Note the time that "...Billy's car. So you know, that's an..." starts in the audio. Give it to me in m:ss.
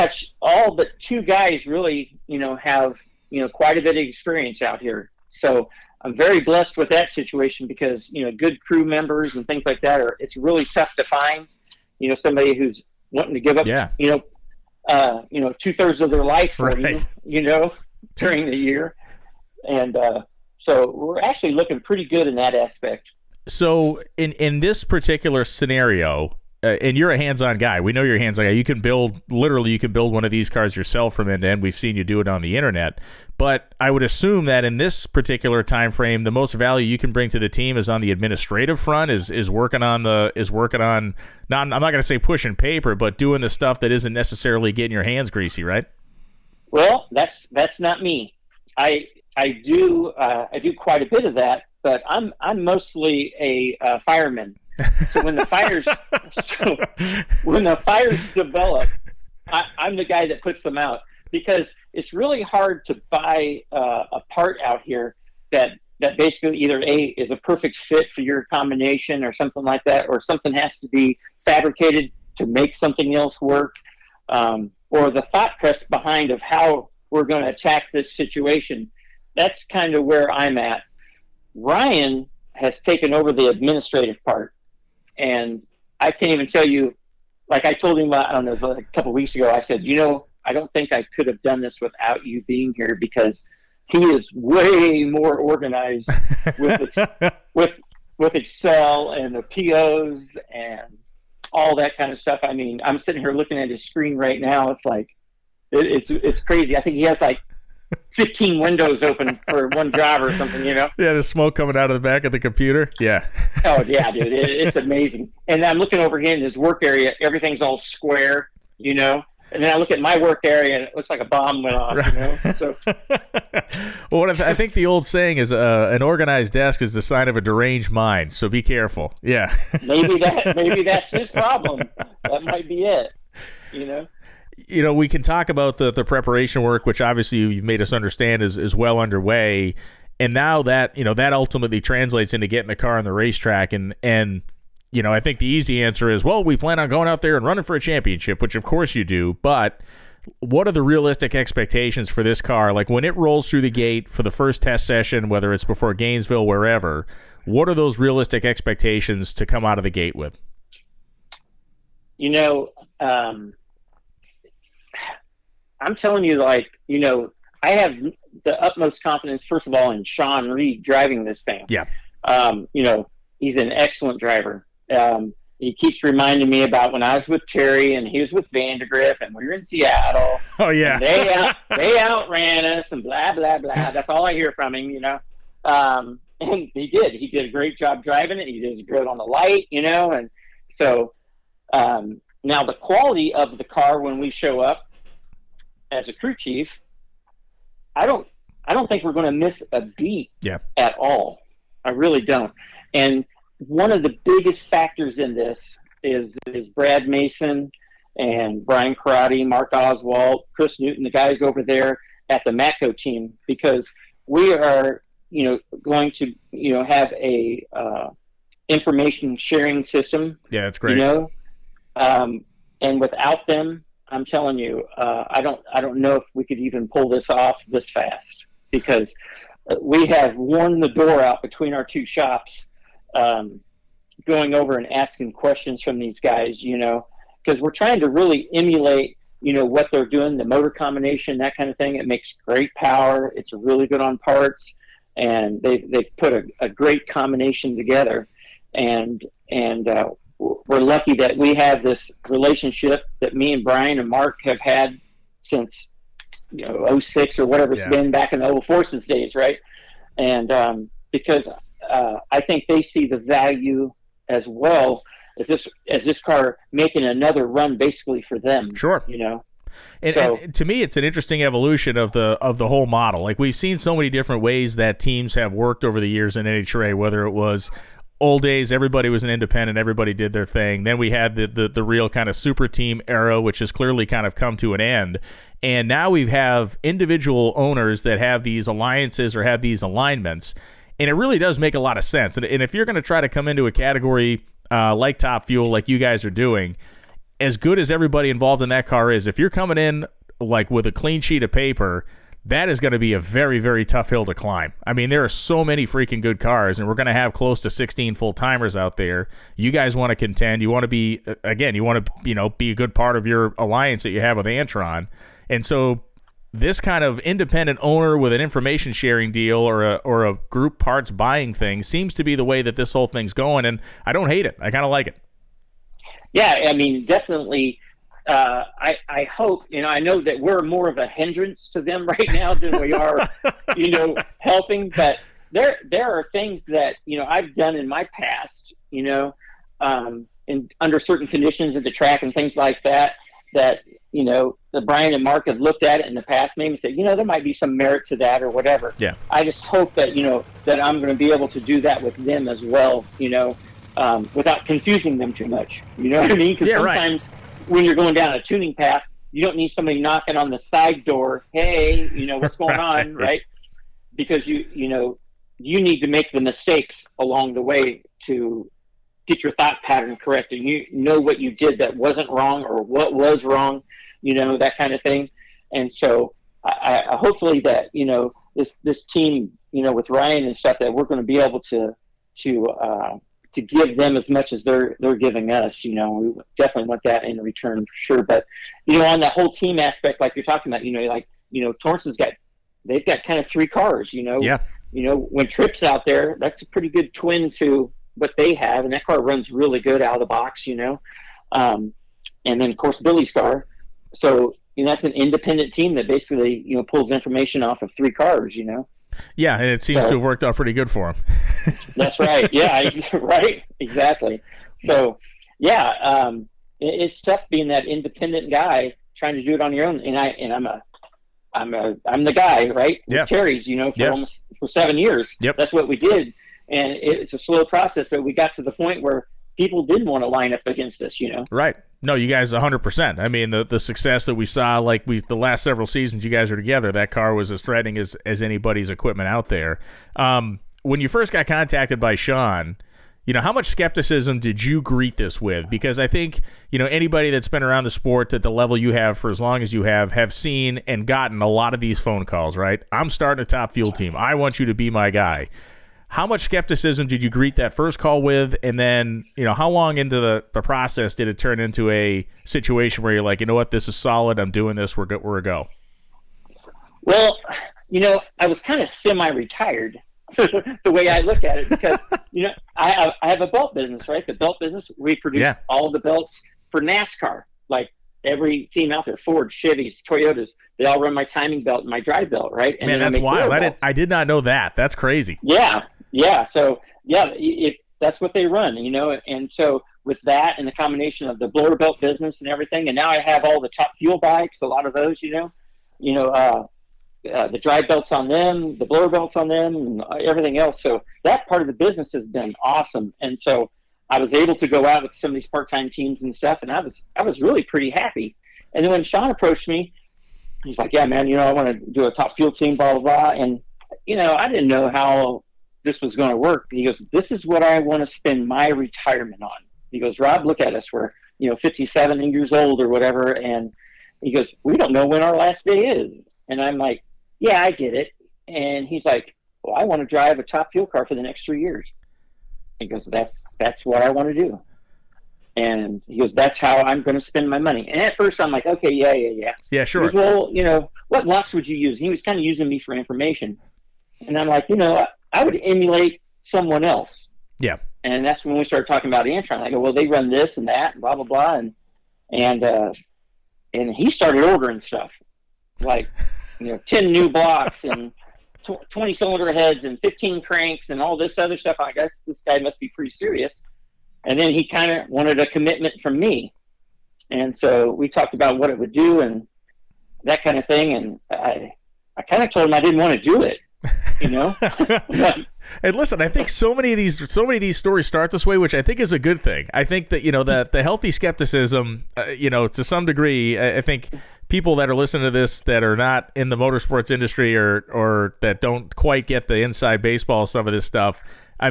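6:42.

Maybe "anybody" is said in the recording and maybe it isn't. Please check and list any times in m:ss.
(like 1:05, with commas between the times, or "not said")
7:18, 7:26.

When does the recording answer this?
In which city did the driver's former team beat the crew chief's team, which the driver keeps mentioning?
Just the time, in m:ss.
2:59.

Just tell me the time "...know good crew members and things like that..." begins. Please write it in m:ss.
0:08.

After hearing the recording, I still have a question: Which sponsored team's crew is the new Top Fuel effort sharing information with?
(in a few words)
Matco.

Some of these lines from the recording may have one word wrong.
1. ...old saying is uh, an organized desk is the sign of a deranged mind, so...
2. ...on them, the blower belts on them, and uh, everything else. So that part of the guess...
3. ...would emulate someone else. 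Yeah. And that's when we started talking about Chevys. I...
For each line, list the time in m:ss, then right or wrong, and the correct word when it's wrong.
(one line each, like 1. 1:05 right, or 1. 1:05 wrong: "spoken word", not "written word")
1. 2:04 right
2. 8:18 wrong: "business", not "guess"
3. 9:05 wrong: "Antron", not "Chevys".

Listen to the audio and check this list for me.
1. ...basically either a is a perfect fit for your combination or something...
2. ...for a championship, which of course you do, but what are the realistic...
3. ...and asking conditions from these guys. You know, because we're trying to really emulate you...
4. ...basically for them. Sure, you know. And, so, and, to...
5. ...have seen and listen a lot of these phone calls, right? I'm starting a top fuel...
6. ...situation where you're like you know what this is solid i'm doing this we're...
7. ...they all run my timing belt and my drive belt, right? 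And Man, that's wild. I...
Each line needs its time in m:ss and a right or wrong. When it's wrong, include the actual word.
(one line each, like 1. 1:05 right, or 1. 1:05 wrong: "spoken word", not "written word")
1. 1:06 right
2. 2:27 right
3. 3:54 wrong: "questions", not "conditions"
4. 4:27 right
5. 7:30 wrong: "gotten", not "listen"
6. 7:42 right
7. 8:00 right.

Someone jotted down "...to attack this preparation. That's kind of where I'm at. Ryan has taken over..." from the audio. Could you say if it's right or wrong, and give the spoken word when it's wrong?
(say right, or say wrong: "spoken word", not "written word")
wrong: "situation", not "preparation".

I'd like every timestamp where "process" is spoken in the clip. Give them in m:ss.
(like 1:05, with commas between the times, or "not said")
7:07, 7:40.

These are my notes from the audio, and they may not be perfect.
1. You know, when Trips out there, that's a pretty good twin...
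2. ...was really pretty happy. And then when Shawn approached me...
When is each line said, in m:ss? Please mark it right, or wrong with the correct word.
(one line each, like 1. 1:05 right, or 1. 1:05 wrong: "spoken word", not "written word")
1. 6:34 right
2. 8:27 right.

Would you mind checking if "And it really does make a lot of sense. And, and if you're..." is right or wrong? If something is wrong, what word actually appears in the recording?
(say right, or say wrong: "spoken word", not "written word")
right.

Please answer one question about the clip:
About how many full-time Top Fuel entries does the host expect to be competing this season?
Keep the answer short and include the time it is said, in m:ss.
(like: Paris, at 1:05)
16, at 5:07.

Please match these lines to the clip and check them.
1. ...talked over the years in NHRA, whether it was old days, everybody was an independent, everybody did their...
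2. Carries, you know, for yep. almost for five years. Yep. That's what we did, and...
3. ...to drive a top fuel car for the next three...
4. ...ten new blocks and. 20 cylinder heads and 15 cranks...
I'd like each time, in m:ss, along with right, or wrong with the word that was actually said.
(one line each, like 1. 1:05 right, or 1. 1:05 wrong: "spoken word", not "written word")
1. 4:35 wrong: "worked", not "talked"
2. 7:03 wrong: "seven", not "five"
3. 8:50 right
4. 9:16 right.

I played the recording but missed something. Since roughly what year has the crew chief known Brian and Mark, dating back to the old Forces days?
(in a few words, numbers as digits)
2006.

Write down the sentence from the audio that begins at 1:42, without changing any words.
I mean, I'm sitting here looking at his screen right now.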